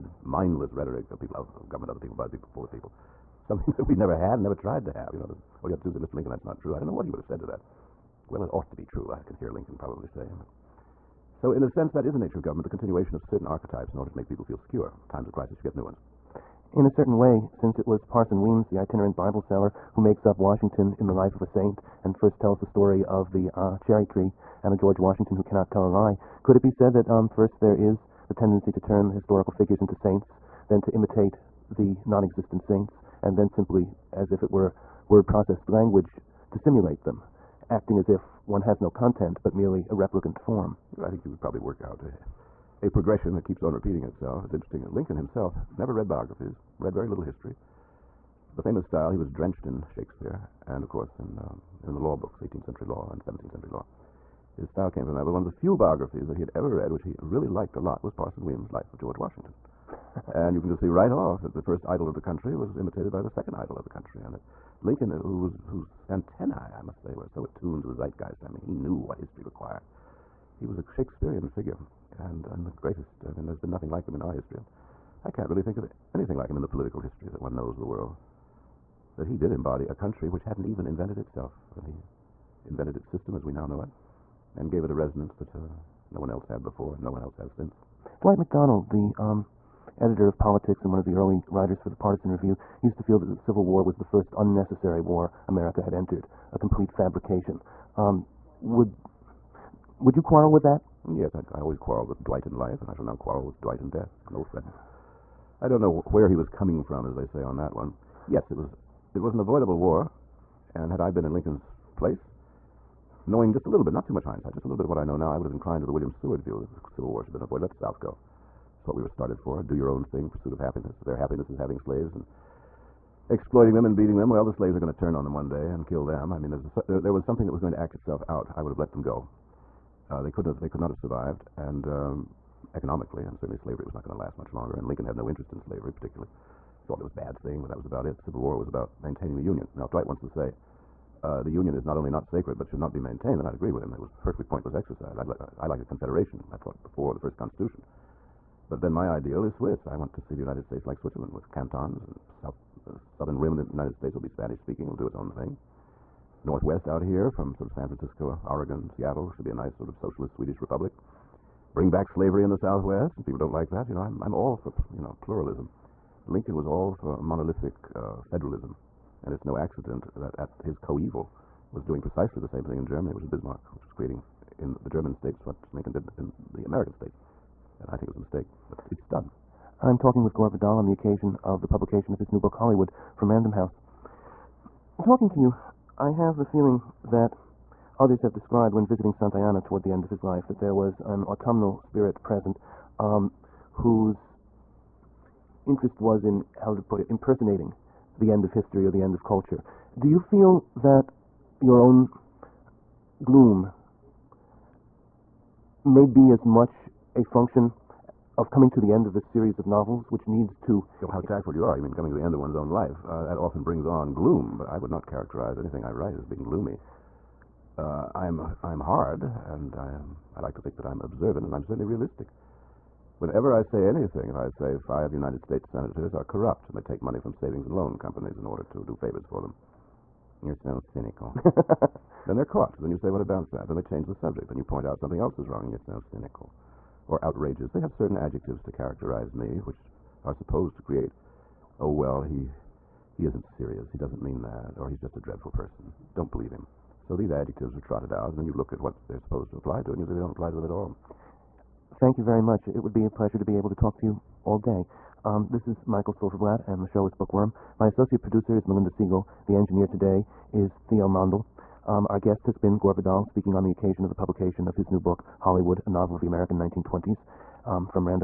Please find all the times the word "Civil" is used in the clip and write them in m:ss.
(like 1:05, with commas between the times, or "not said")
1:33, 1:56, 2:18.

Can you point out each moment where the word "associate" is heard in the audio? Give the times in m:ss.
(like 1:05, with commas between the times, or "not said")
4:17.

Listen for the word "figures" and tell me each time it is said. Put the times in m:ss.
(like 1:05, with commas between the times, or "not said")
0:29, 1:11.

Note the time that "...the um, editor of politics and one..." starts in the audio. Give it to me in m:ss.
1:28.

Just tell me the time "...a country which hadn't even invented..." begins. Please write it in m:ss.
1:19.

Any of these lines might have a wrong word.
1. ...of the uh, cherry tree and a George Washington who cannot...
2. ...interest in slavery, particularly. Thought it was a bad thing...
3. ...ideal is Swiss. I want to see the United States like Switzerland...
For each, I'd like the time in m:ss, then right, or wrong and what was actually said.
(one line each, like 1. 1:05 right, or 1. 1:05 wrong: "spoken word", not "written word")
1. 0:23 right
2. 2:15 right
3. 2:29 right.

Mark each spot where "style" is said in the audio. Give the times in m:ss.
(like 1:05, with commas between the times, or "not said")
0:48, 0:54.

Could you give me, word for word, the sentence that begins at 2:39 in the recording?
Should be a nice sort of socialist Swedish republic.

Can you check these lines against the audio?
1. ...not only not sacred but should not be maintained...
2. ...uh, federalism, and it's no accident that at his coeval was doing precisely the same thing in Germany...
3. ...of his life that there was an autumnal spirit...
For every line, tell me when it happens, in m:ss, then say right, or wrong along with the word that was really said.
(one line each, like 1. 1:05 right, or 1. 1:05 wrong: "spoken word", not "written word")
1. 2:21 right
2. 2:47 right
3. 3:10 right.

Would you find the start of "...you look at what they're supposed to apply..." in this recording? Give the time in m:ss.
4:08.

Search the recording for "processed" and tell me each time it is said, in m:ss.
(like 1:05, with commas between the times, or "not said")
0:35.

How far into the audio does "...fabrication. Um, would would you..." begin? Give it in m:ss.
1:36.